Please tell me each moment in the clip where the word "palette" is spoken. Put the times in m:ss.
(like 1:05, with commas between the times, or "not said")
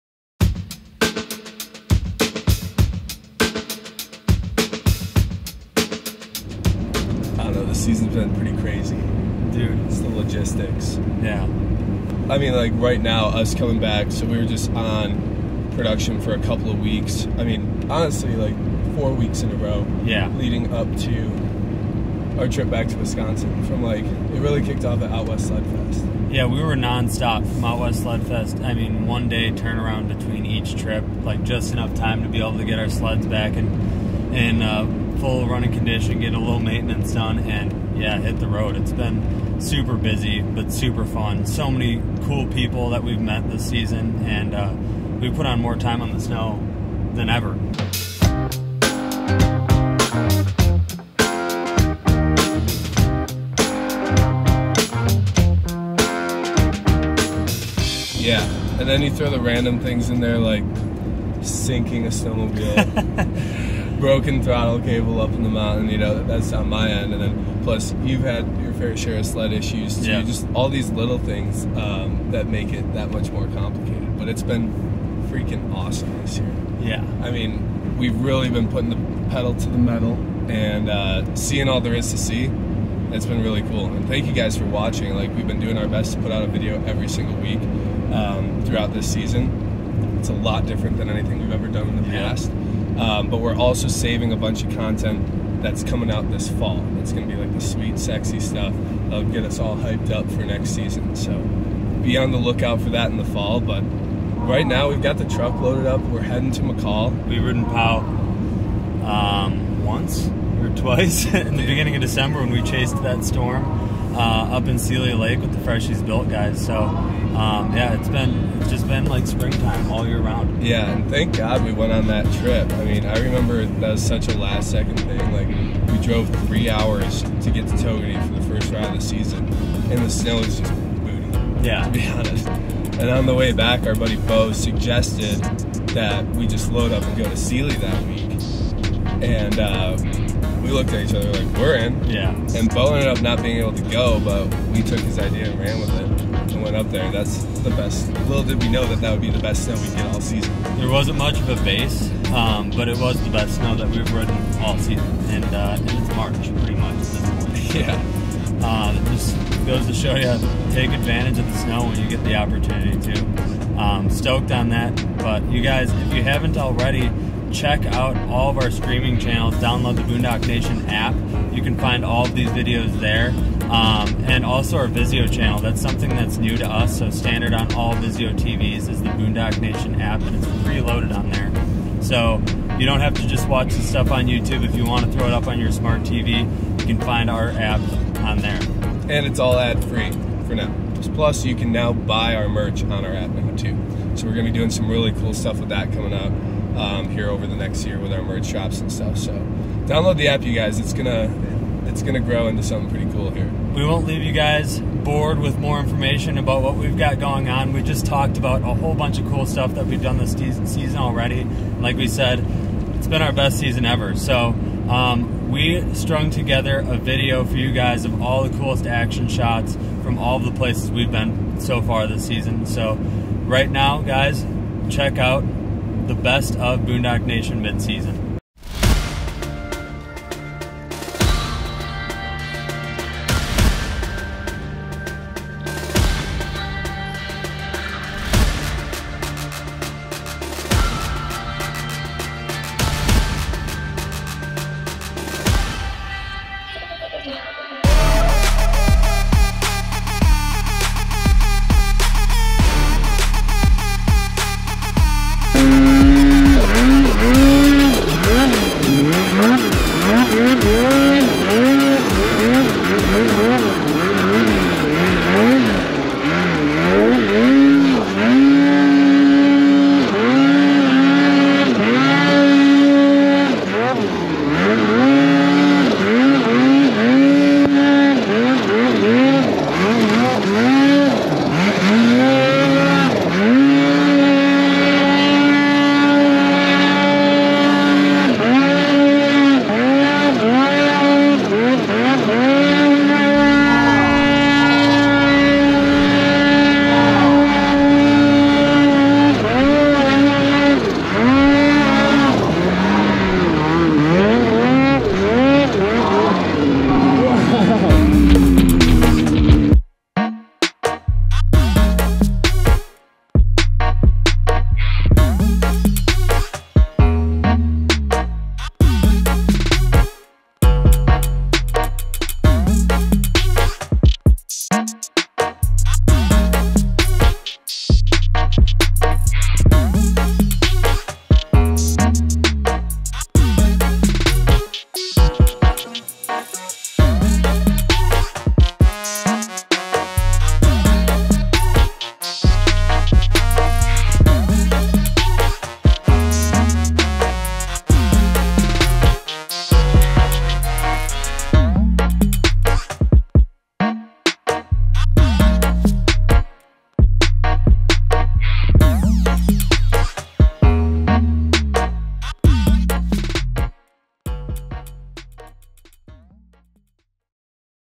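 not said.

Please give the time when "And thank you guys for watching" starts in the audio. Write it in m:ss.
1:23.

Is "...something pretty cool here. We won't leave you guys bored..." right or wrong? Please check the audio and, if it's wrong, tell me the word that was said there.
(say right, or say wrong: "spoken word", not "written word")
right.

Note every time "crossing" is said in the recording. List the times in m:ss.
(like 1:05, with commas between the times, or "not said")
not said.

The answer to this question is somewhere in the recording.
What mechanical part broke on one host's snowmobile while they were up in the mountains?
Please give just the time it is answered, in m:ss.
1:04.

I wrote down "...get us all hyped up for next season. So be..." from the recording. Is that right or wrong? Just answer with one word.
right.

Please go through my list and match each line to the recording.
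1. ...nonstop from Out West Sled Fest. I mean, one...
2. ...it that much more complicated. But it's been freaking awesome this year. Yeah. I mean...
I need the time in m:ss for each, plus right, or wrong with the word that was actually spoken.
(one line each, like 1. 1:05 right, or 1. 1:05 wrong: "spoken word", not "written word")
1. 0:26 right
2. 1:12 right.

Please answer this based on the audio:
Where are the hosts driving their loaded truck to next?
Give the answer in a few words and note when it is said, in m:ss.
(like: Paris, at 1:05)
McCall, at 1:46.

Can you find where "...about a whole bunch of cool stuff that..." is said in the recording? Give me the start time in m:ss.
3:28.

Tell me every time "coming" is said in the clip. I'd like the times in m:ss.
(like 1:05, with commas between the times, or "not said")
0:13, 1:35, 3:15.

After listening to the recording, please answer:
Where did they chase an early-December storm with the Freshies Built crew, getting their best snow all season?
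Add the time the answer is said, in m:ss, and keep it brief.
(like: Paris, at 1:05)
Seeley Lake, at 1:54.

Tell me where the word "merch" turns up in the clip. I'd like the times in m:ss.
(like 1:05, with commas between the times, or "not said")
3:12, 3:18.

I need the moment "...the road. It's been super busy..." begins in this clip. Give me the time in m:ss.
0:38.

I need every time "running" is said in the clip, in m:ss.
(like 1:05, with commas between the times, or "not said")
0:35.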